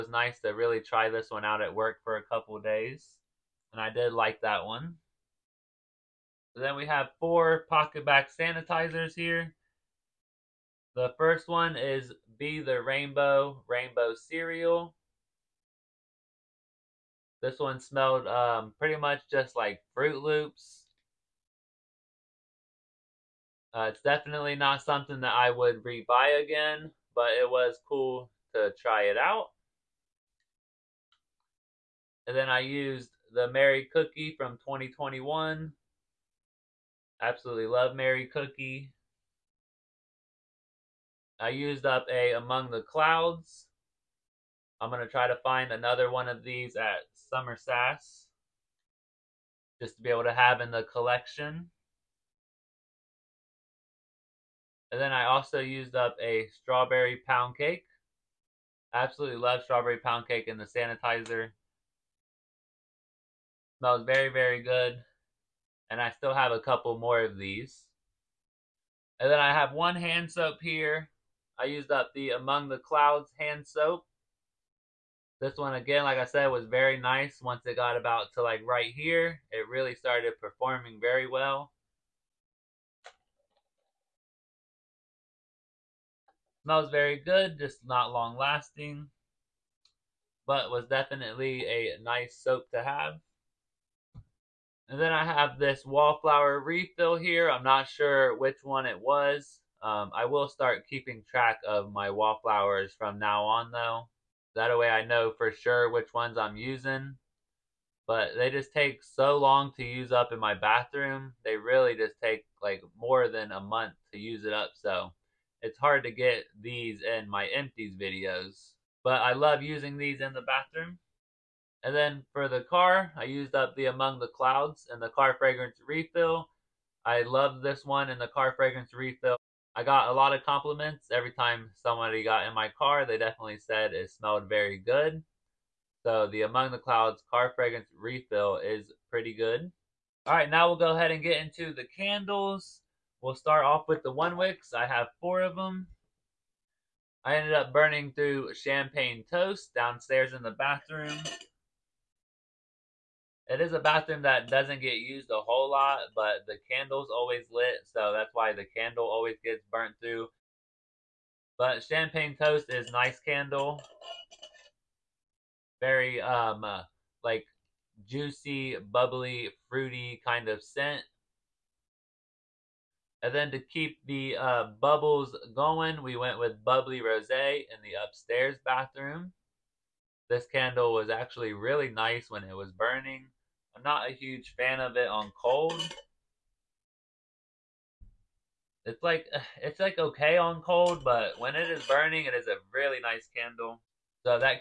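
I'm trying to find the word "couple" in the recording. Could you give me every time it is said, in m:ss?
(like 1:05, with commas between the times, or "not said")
0:02, 1:06.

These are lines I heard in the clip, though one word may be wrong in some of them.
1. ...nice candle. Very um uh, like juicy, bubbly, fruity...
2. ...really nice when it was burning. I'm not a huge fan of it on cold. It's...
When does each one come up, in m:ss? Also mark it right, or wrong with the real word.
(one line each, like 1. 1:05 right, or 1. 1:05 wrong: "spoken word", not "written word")
1. 2:42 right
2. 3:01 right.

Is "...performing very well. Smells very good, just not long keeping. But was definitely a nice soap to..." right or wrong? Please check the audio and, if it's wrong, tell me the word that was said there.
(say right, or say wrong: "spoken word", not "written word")
wrong: "lasting", not "keeping".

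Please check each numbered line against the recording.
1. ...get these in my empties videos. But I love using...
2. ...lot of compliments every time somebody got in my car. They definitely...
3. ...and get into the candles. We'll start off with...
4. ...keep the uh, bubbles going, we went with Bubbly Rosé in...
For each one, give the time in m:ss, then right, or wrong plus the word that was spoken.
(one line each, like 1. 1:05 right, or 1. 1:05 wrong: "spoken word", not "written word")
1. 1:56 right
2. 2:10 right
3. 2:21 right
4. 2:53 right.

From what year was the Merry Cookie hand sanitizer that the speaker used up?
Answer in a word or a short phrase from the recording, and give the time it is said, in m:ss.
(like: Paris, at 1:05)
2021, at 0:34.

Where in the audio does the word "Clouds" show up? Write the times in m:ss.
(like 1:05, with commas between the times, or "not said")
0:42, 1:12, 2:04, 2:16.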